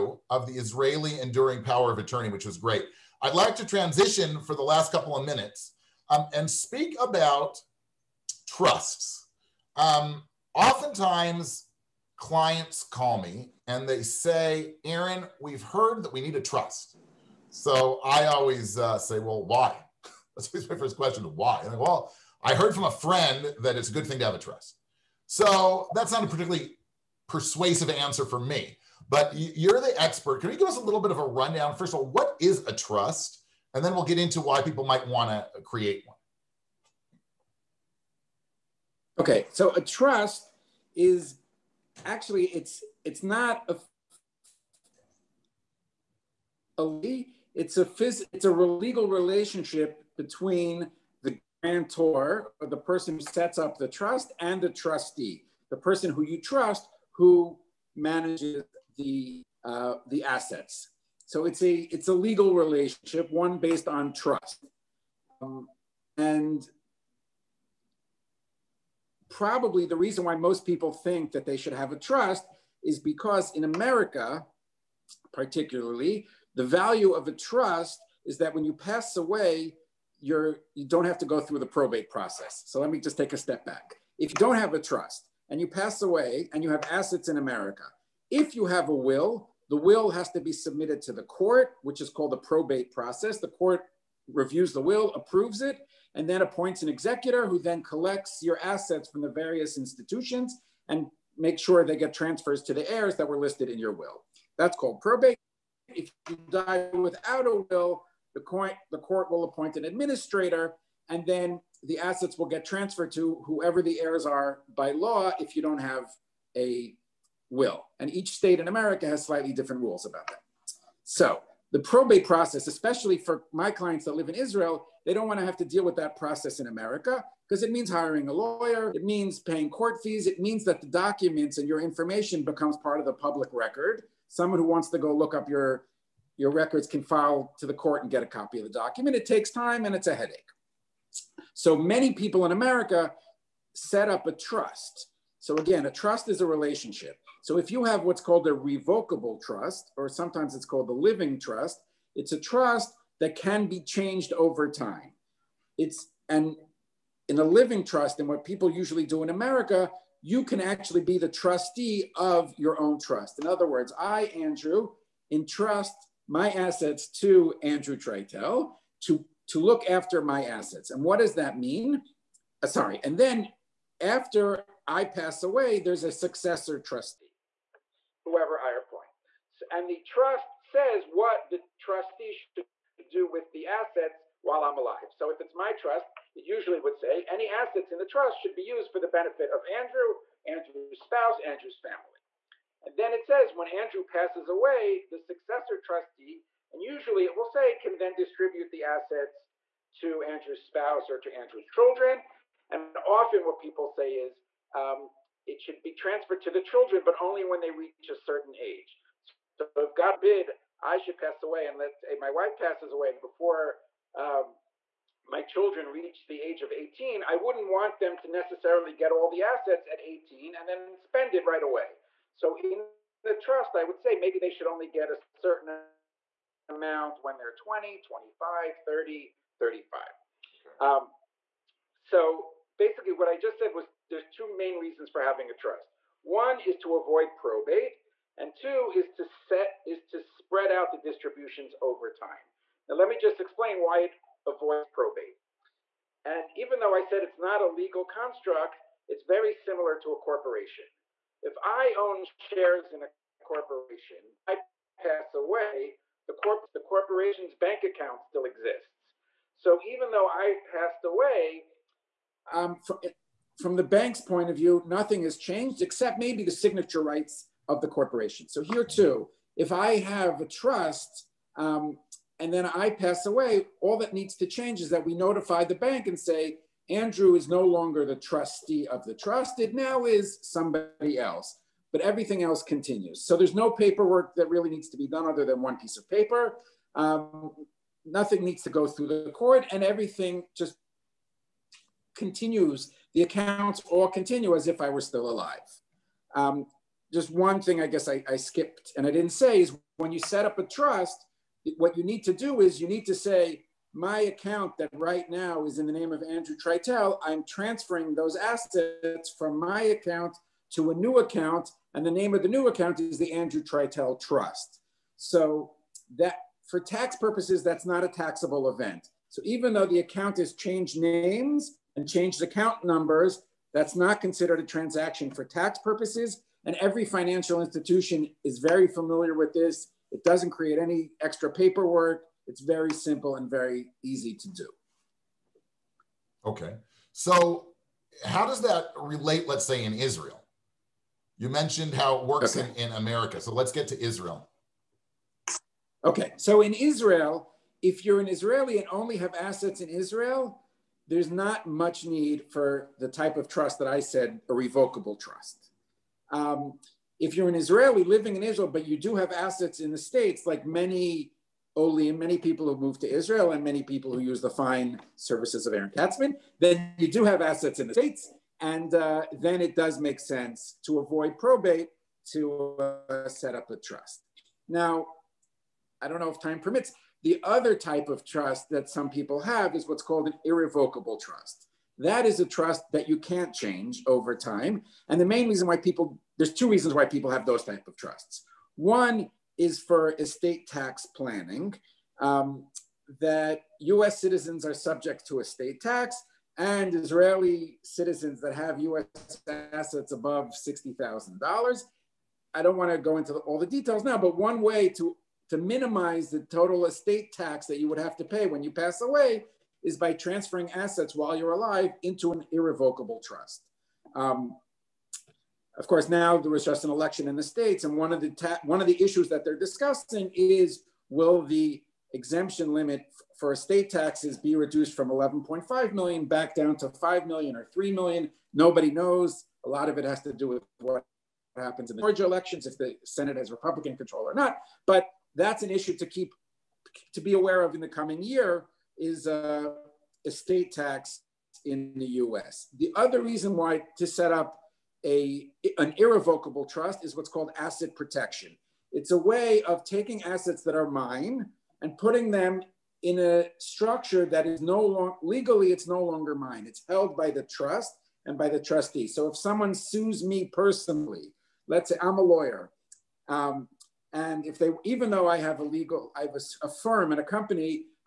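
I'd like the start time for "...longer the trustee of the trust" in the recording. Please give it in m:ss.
4:37.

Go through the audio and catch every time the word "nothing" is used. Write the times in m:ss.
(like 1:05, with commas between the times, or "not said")
4:24, 4:48.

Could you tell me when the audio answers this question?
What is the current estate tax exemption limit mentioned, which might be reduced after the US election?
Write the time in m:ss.
7:05.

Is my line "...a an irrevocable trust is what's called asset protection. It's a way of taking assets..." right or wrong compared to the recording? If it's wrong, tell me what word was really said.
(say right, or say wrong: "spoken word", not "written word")
right.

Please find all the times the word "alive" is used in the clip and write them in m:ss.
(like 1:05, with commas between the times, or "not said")
3:04, 4:55, 6:51.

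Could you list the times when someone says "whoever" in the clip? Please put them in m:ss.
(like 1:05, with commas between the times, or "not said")
1:53, 2:58.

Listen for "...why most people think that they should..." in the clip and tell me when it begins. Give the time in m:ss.
1:10.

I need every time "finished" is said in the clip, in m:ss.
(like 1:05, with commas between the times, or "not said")
not said.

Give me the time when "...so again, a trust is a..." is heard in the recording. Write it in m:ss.
2:25.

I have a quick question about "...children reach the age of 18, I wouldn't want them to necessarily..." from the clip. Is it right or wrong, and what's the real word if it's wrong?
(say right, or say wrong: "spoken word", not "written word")
right.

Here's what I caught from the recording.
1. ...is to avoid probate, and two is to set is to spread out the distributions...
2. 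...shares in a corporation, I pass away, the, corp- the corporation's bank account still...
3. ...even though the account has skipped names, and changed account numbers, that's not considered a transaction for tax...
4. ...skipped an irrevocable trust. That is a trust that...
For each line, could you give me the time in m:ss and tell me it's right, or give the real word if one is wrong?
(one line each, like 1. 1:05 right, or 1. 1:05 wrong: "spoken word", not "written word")
1. 3:56 right
2. 4:12 right
3. 5:19 wrong: "changed", not "skipped"
4. 6:20 wrong: "called", not "skipped".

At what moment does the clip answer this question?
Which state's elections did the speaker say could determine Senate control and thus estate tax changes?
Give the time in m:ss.
7:12.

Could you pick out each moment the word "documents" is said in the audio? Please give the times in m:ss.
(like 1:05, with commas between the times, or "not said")
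2:10, 2:18.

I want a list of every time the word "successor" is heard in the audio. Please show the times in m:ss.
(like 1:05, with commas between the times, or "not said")
2:56, 3:15.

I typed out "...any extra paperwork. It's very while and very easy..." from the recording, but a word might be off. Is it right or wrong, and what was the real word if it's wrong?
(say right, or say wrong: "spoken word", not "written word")
wrong: "simple", not "while".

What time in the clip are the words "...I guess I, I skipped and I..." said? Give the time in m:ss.
4:57.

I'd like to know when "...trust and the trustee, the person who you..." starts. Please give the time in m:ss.
0:53.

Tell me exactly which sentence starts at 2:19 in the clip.
It takes time and it's a headache.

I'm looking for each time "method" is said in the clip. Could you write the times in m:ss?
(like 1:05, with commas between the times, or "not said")
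not said.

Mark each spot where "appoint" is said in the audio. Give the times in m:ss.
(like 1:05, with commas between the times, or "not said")
1:36, 1:49, 2:58.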